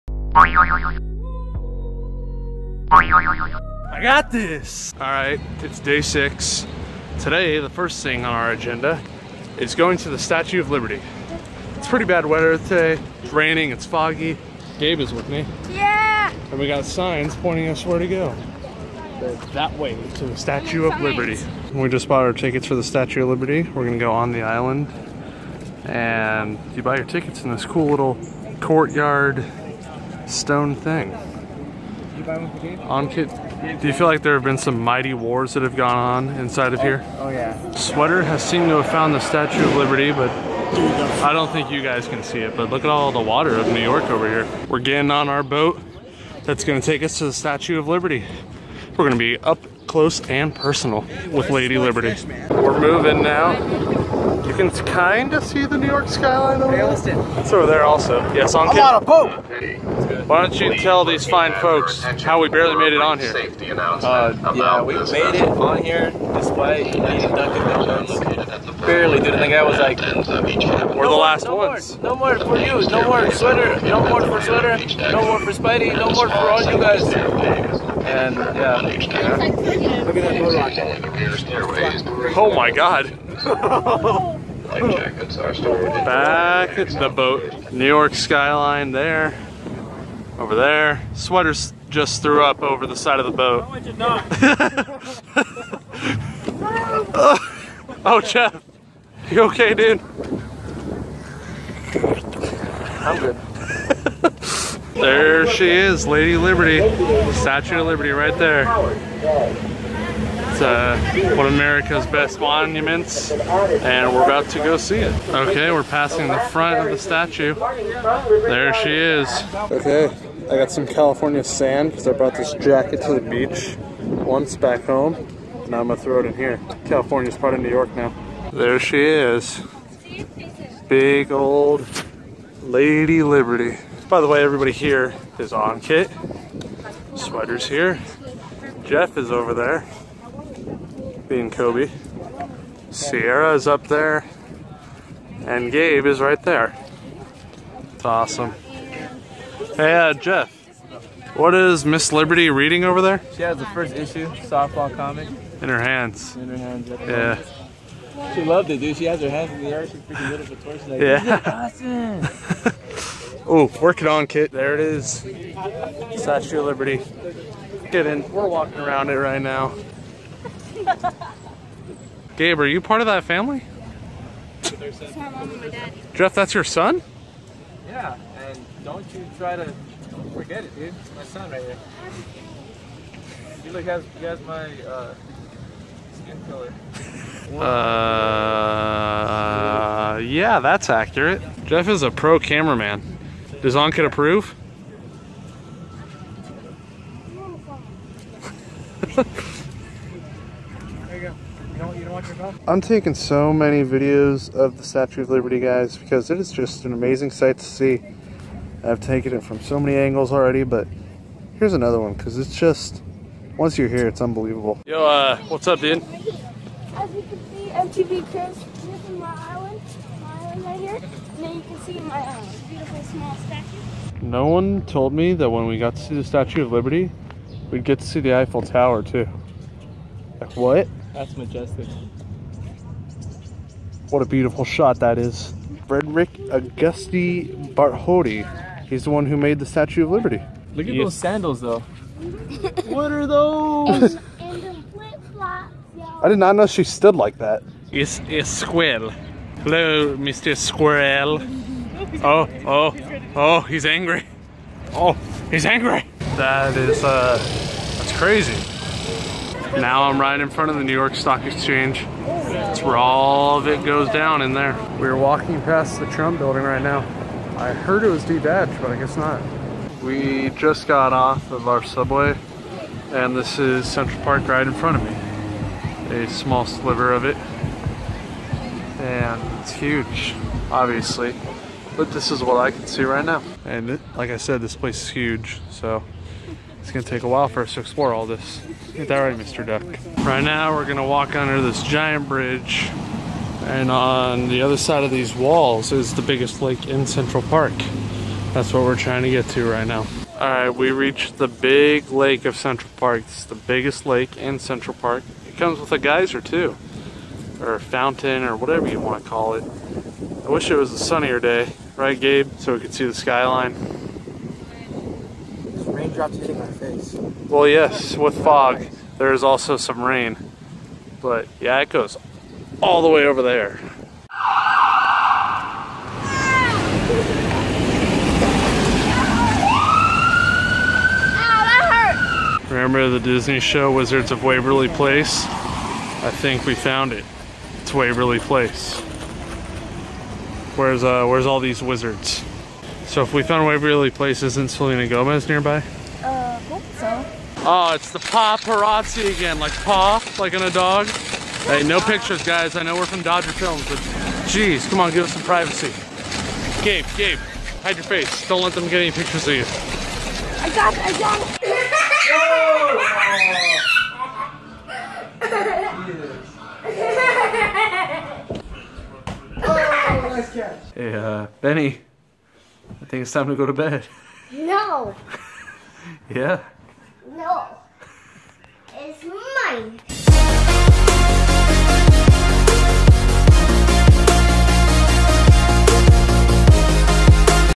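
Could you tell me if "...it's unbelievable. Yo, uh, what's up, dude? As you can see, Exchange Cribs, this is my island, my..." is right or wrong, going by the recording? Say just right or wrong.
wrong.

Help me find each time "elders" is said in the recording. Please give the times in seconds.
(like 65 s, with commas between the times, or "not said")
not said.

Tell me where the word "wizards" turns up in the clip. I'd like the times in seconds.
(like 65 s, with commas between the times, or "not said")
333 s, 341 s.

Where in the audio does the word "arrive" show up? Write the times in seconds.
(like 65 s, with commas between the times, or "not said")
not said.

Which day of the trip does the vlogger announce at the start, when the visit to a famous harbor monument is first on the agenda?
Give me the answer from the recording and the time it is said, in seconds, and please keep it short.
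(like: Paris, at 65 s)
Day six, at 5 s.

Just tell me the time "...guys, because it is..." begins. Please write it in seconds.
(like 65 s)
205 s.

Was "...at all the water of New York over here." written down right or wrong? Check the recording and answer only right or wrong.
right.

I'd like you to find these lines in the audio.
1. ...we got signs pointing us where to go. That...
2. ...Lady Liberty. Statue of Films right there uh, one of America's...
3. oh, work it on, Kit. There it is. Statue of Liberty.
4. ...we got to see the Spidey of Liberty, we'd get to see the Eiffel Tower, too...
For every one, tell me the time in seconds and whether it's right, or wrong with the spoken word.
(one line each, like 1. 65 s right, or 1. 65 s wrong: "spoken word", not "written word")
1. 16 s right
2. 106 s wrong: "Liberty", not "Films"
3. 163 s right
4. 225 s wrong: "Statue", not "Spidey".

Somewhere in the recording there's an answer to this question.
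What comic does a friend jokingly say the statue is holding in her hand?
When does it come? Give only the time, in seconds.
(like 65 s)
153 s.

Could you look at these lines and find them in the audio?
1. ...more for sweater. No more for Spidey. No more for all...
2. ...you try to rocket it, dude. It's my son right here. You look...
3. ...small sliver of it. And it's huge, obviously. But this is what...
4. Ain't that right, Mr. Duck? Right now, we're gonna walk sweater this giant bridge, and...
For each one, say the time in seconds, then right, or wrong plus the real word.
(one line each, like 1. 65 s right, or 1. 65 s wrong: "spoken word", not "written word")
1. 74 s right
2. 179 s wrong: "forget", not "rocket"
3. 276 s right
4. 288 s wrong: "under", not "sweater".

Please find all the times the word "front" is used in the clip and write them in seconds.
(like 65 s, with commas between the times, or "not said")
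116 s, 260 s, 274 s.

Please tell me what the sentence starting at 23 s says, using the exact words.
We're gonna go on the island.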